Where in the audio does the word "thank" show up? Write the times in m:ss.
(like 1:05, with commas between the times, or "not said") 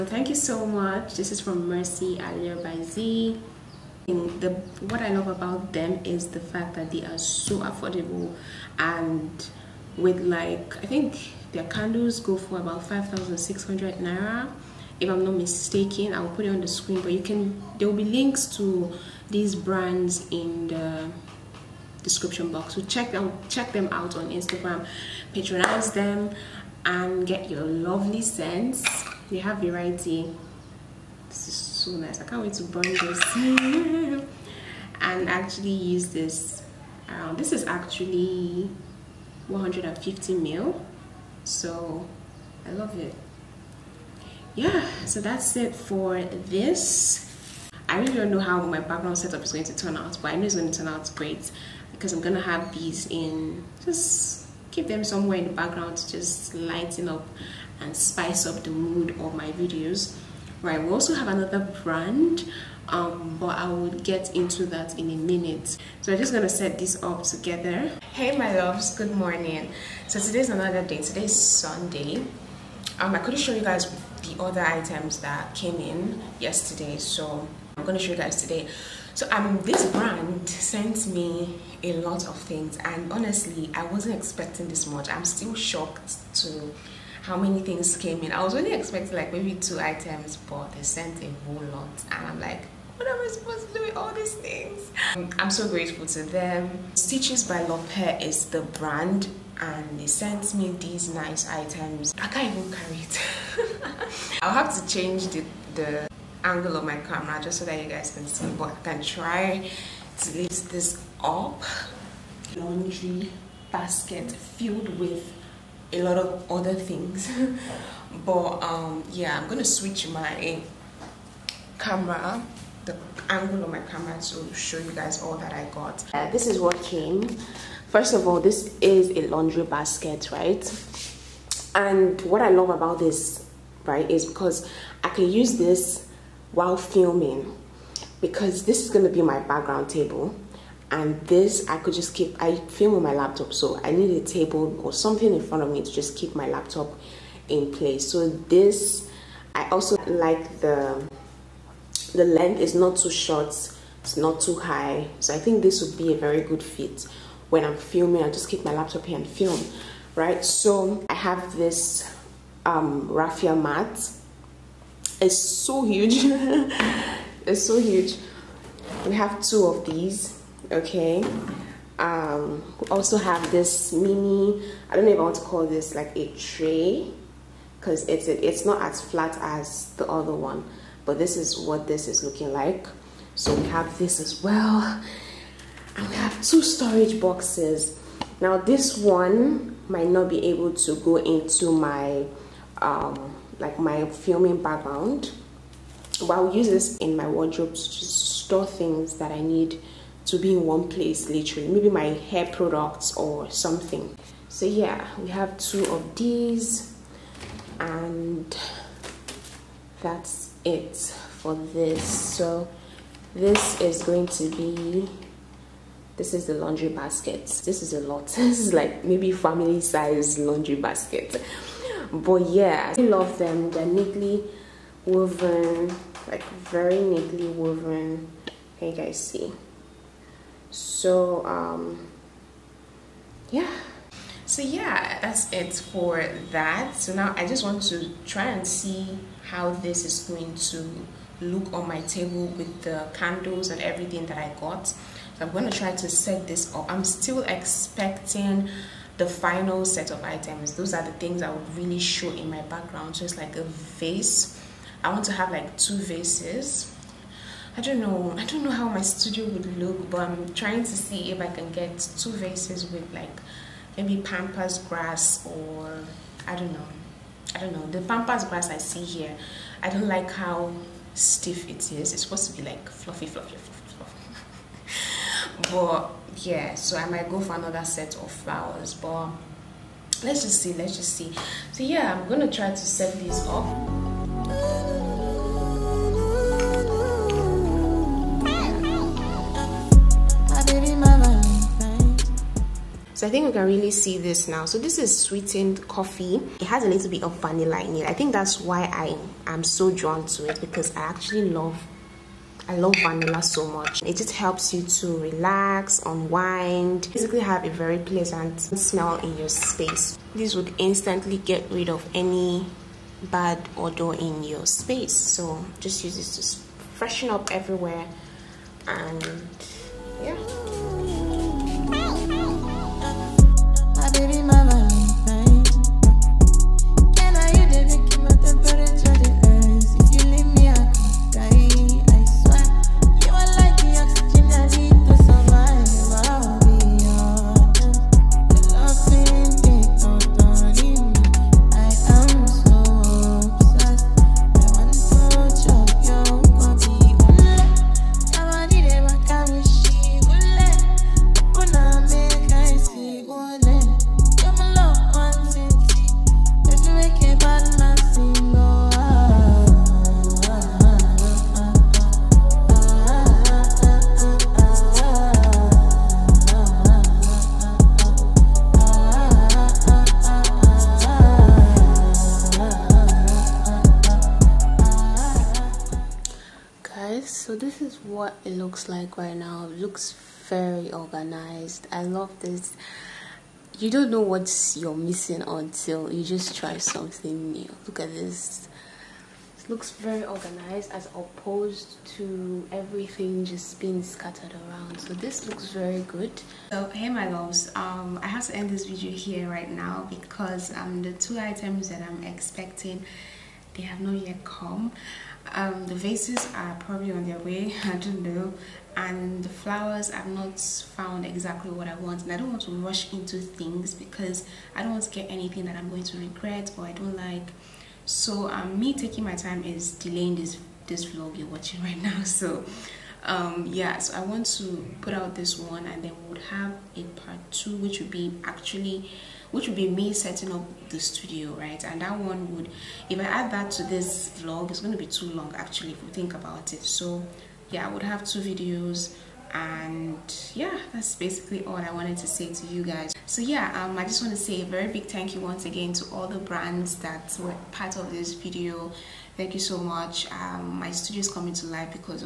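0:00, 7:25, 7:29.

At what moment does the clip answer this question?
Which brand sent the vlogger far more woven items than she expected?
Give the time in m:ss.
1:36.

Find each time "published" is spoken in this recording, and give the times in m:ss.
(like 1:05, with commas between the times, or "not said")
not said.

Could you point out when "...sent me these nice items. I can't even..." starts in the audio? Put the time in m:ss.
1:40.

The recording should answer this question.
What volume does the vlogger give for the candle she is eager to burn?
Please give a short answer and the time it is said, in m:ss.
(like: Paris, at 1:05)
150 ml, at 0:39.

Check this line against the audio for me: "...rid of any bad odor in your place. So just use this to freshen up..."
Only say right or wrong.
wrong.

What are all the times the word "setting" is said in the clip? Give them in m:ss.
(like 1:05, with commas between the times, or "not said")
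7:10.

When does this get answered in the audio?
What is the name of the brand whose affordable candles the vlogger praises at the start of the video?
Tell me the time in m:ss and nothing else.
0:01.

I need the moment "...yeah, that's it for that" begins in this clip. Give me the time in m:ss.
3:54.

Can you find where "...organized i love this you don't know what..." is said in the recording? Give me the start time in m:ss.
6:20.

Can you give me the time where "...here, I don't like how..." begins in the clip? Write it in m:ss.
4:29.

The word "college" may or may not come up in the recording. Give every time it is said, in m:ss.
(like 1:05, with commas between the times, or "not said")
not said.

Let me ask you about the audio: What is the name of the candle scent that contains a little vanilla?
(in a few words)
sweetened coffee.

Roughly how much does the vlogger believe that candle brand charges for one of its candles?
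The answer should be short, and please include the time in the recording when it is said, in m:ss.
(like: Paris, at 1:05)
5,600 naira, at 0:12.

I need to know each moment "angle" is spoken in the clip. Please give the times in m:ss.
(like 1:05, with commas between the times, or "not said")
1:46, 2:03.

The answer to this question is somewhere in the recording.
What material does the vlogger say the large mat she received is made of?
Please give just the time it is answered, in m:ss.
2:43.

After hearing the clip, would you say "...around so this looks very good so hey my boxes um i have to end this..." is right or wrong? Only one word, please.
wrong.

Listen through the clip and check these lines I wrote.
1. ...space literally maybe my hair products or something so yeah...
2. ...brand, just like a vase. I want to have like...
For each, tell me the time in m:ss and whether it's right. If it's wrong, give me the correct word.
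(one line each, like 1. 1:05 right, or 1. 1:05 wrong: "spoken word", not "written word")
1. 3:20 wrong: "place", not "space"
2. 4:12 wrong: "background", not "brand".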